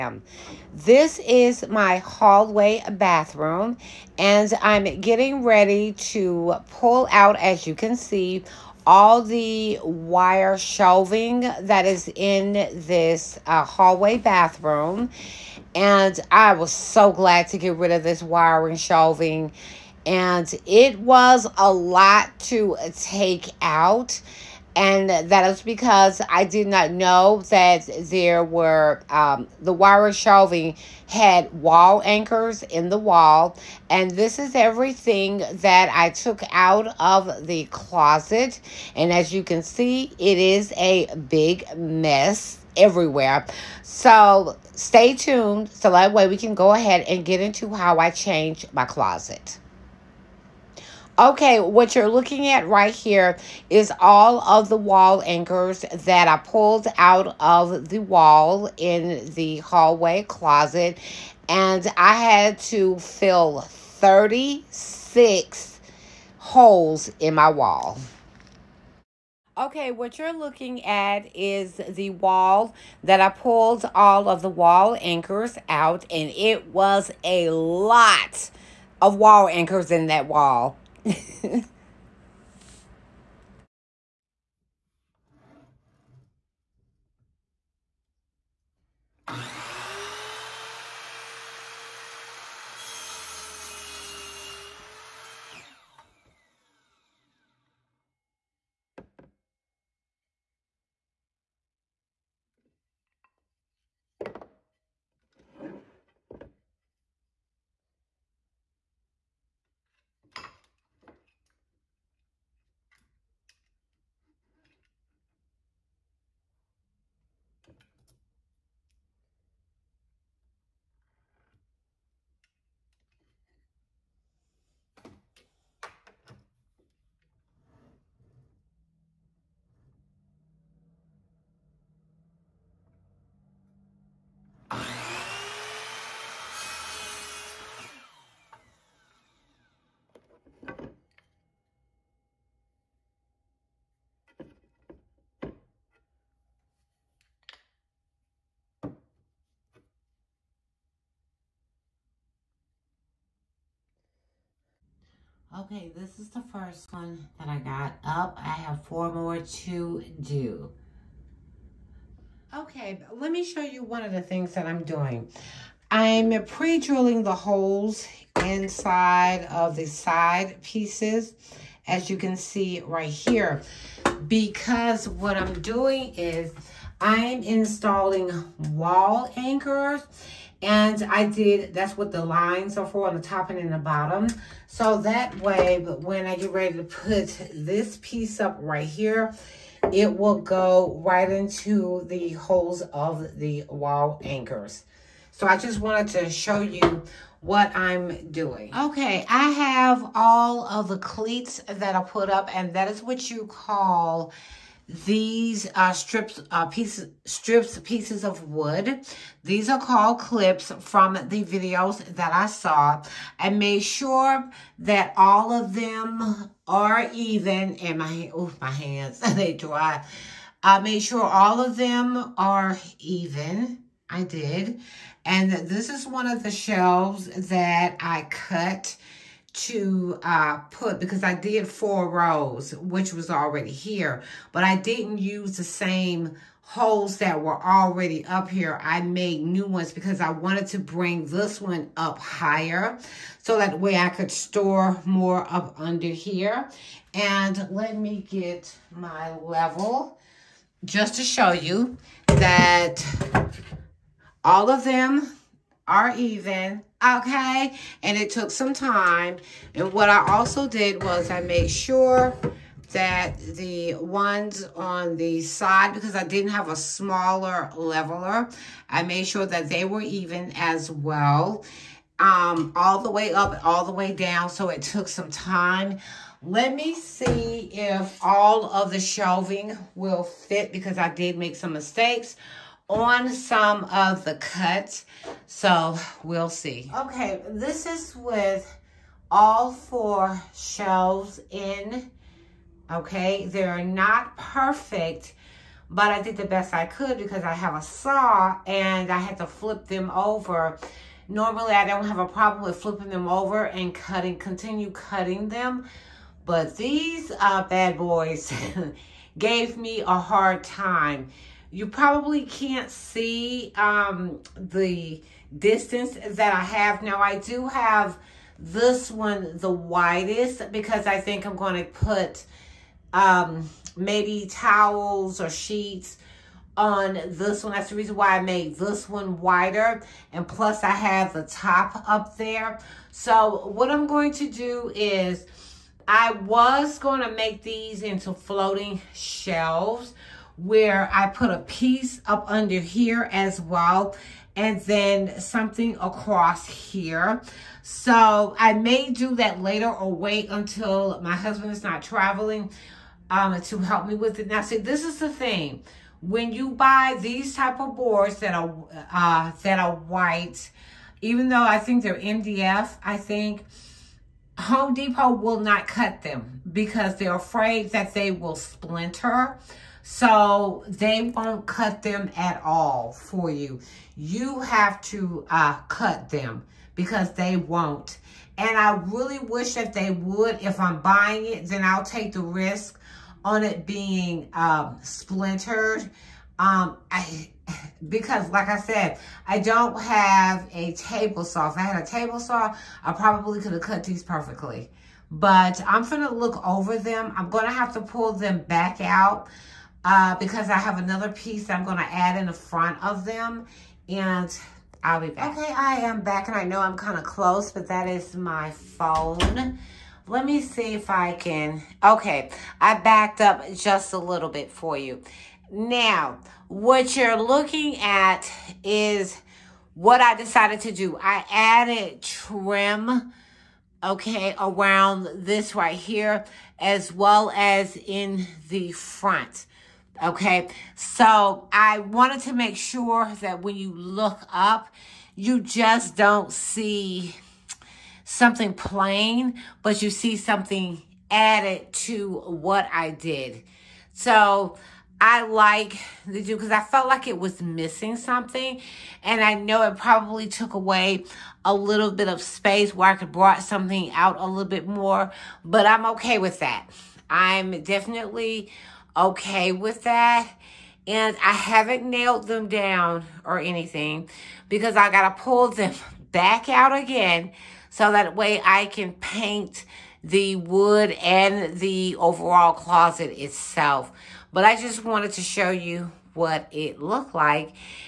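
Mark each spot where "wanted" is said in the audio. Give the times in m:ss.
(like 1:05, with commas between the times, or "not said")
3:15, 4:00, 7:12, 7:55.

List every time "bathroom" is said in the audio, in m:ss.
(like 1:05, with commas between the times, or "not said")
0:02, 0:14.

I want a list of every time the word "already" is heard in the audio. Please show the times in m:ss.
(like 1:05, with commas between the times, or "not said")
3:53, 3:57.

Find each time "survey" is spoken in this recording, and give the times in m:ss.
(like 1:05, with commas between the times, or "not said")
not said.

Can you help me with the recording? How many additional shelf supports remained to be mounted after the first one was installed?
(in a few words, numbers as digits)
4.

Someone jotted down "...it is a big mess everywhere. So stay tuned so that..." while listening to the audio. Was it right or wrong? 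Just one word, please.
right.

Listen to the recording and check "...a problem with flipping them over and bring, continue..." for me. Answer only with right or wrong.
wrong.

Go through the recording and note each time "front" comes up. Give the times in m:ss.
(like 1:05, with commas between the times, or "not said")
6:42, 7:08.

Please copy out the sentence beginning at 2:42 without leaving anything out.
Okay, let me show you one of the things that I'm doing.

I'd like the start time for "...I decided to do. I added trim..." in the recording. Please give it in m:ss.
7:00.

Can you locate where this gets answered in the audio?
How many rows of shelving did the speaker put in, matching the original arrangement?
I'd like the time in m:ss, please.
3:51.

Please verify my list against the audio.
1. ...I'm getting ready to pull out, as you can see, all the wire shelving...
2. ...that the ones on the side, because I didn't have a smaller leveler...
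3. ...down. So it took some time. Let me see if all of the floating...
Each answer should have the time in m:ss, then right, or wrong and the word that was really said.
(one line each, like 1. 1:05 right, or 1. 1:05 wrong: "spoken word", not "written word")
1. 0:04 right
2. 4:22 right
3. 4:34 wrong: "shelving", not "floating".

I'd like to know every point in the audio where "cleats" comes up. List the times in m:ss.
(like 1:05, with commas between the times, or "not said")
3:20, 3:30.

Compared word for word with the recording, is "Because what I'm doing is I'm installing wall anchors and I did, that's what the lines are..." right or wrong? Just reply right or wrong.
right.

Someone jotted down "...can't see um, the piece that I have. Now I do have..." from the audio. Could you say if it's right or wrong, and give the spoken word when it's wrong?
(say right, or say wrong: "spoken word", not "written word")
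wrong: "distance", not "piece".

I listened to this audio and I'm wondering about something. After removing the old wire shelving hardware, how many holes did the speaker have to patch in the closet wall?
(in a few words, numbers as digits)
36.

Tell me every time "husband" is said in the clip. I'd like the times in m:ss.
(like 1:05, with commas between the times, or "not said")
5:51.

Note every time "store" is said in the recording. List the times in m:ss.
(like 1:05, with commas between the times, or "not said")
4:04.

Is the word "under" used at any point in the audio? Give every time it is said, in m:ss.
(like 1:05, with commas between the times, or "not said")
4:05, 5:42.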